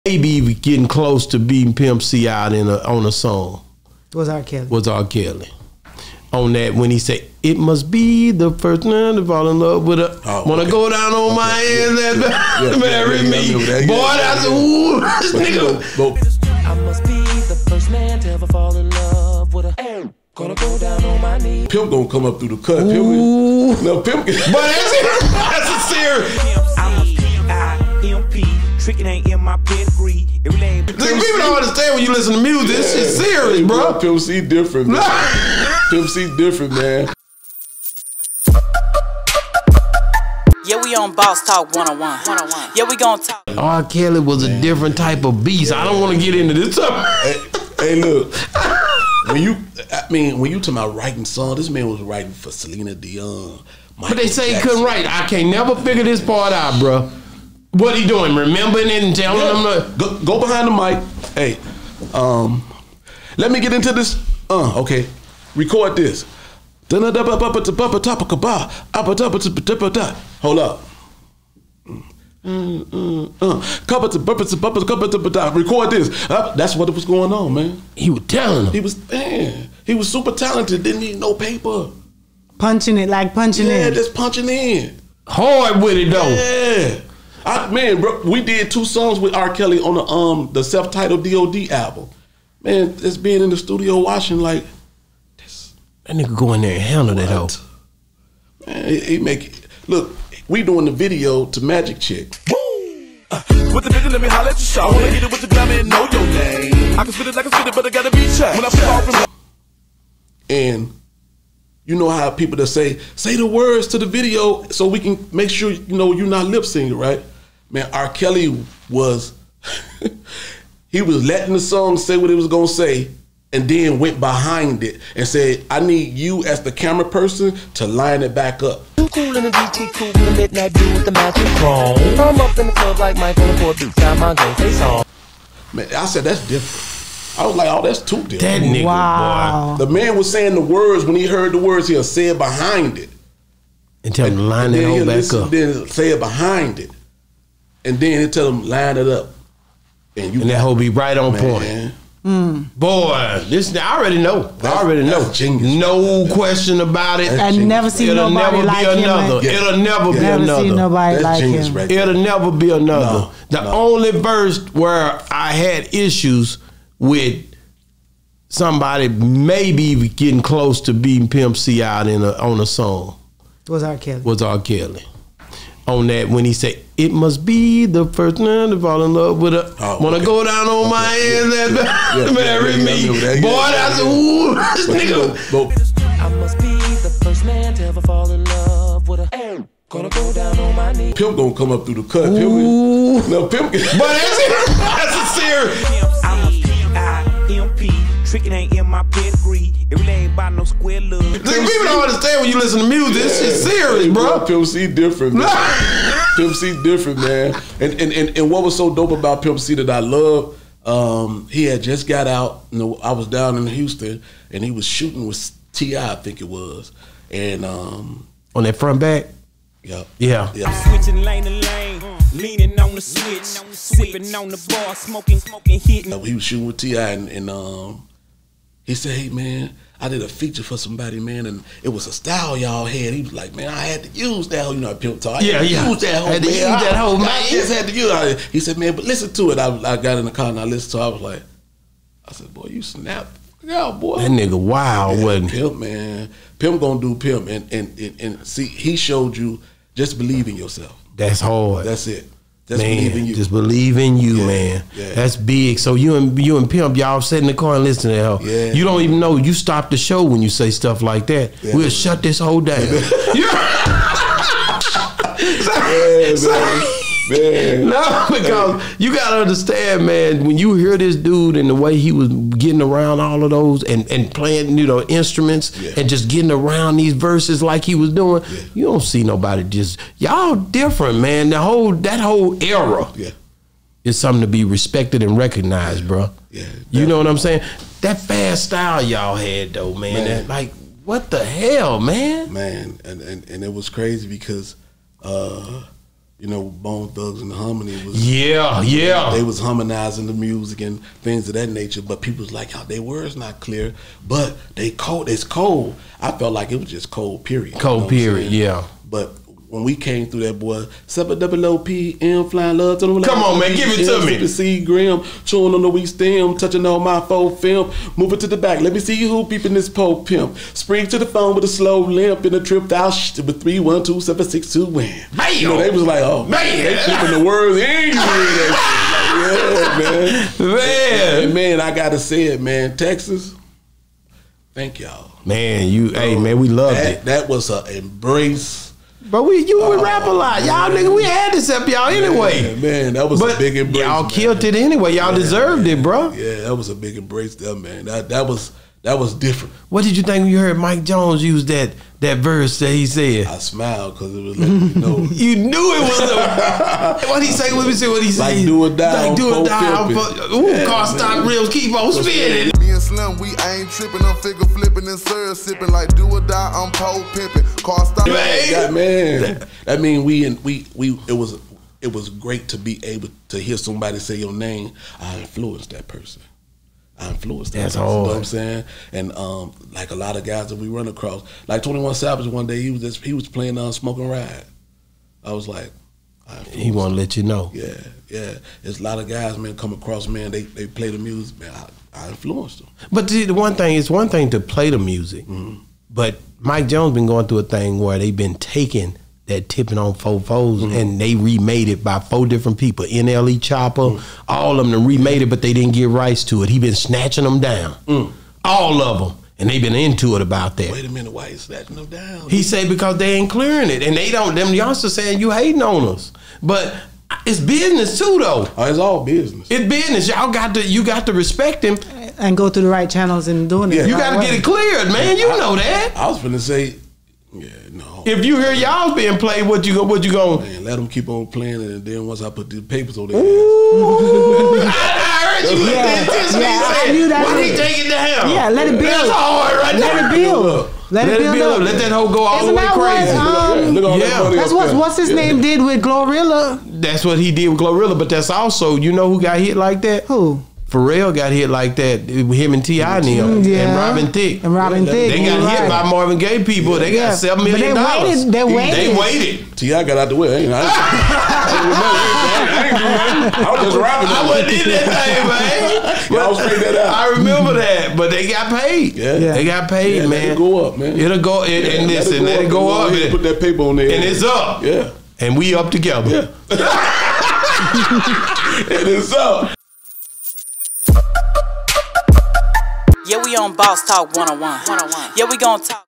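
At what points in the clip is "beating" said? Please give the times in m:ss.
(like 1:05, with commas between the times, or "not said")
0:01, 2:50.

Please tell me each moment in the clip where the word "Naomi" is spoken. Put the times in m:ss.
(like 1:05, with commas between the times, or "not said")
not said.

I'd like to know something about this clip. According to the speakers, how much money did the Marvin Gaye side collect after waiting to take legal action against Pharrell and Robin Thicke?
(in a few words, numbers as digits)
$7 million.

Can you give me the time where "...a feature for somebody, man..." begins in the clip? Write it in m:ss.
3:50.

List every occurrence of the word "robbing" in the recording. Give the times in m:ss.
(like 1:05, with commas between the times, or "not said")
7:43.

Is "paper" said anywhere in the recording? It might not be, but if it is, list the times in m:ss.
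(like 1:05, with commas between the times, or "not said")
1:21, 7:12, 7:53.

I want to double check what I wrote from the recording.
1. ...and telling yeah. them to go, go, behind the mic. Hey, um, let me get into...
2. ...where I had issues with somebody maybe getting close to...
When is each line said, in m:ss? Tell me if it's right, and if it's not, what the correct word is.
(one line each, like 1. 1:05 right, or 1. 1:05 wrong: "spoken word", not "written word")
1. 0:59 right
2. 2:44 right.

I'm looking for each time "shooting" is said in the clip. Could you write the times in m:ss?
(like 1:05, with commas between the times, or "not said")
3:34, 3:46.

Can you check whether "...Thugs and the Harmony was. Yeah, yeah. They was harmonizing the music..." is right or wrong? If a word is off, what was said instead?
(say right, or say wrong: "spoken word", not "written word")
right.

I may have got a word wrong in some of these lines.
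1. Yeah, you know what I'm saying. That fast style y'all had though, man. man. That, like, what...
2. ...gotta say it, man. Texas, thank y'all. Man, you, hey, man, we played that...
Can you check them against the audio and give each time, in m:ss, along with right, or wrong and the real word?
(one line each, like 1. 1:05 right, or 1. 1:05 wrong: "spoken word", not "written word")
1. 4:46 right
2. 5:31 wrong: "loved", not "played".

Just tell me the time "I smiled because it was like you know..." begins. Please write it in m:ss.
5:53.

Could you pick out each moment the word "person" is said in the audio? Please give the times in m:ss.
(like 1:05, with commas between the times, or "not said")
2:07, 6:16.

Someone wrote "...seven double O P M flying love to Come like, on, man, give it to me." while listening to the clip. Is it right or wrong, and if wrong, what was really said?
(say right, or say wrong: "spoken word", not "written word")
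right.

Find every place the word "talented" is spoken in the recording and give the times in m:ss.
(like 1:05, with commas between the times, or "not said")
1:20.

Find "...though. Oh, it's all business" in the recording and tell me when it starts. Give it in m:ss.
6:58.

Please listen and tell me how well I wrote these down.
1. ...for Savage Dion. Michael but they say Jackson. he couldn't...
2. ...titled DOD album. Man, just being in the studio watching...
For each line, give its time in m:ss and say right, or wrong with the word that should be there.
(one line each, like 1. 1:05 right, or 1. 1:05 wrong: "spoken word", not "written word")
1. 0:52 wrong: "Celine", not "Savage"
2. 1:30 right.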